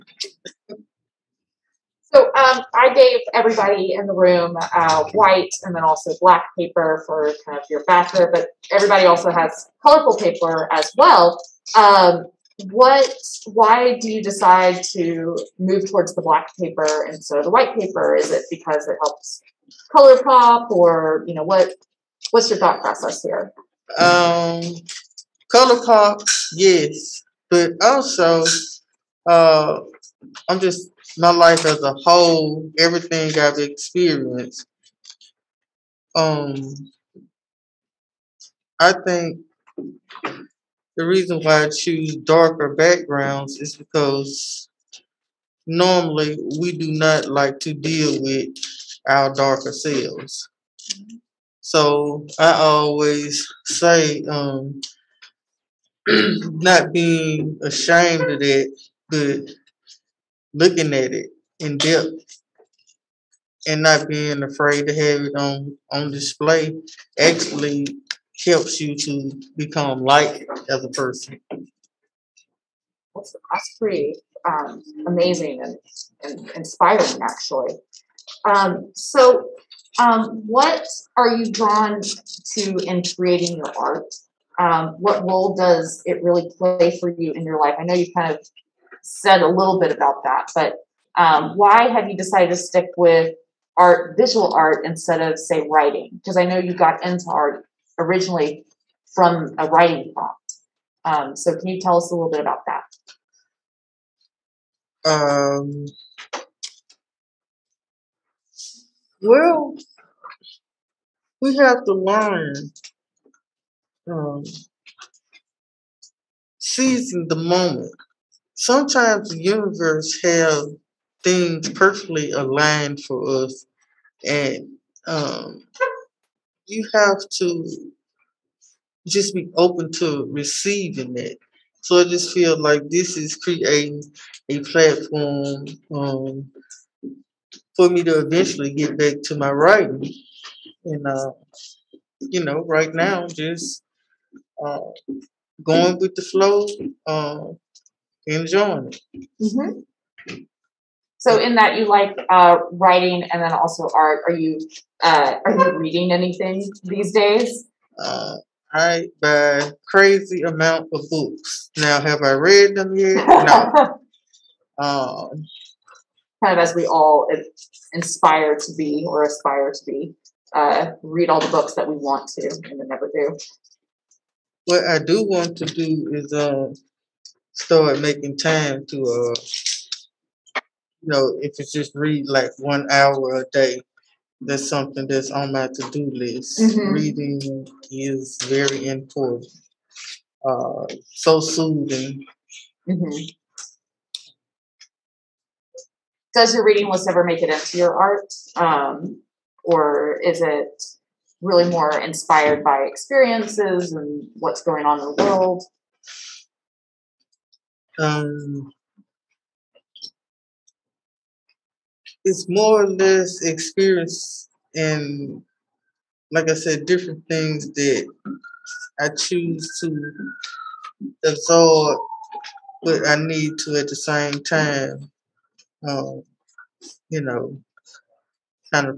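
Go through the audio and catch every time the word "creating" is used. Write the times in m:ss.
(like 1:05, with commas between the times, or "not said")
1:23, 2:13.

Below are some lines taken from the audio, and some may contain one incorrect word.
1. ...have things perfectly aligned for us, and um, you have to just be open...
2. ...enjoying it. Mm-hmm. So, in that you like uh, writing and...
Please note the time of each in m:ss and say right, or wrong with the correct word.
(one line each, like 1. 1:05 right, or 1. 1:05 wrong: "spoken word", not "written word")
1. 2:00 right
2. 2:28 right.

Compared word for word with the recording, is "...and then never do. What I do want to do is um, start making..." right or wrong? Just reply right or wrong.
right.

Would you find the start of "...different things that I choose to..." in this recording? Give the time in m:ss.
3:36.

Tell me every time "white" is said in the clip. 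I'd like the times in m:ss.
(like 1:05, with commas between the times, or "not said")
0:05, 0:17.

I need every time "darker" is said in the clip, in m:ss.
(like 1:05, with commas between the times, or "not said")
0:42, 0:49.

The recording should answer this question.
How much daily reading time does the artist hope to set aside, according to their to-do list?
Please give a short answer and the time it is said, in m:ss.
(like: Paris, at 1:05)
1 hour, at 3:02.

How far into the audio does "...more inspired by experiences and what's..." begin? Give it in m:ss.
3:21.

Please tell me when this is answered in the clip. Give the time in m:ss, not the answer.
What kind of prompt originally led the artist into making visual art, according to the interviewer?
1:39.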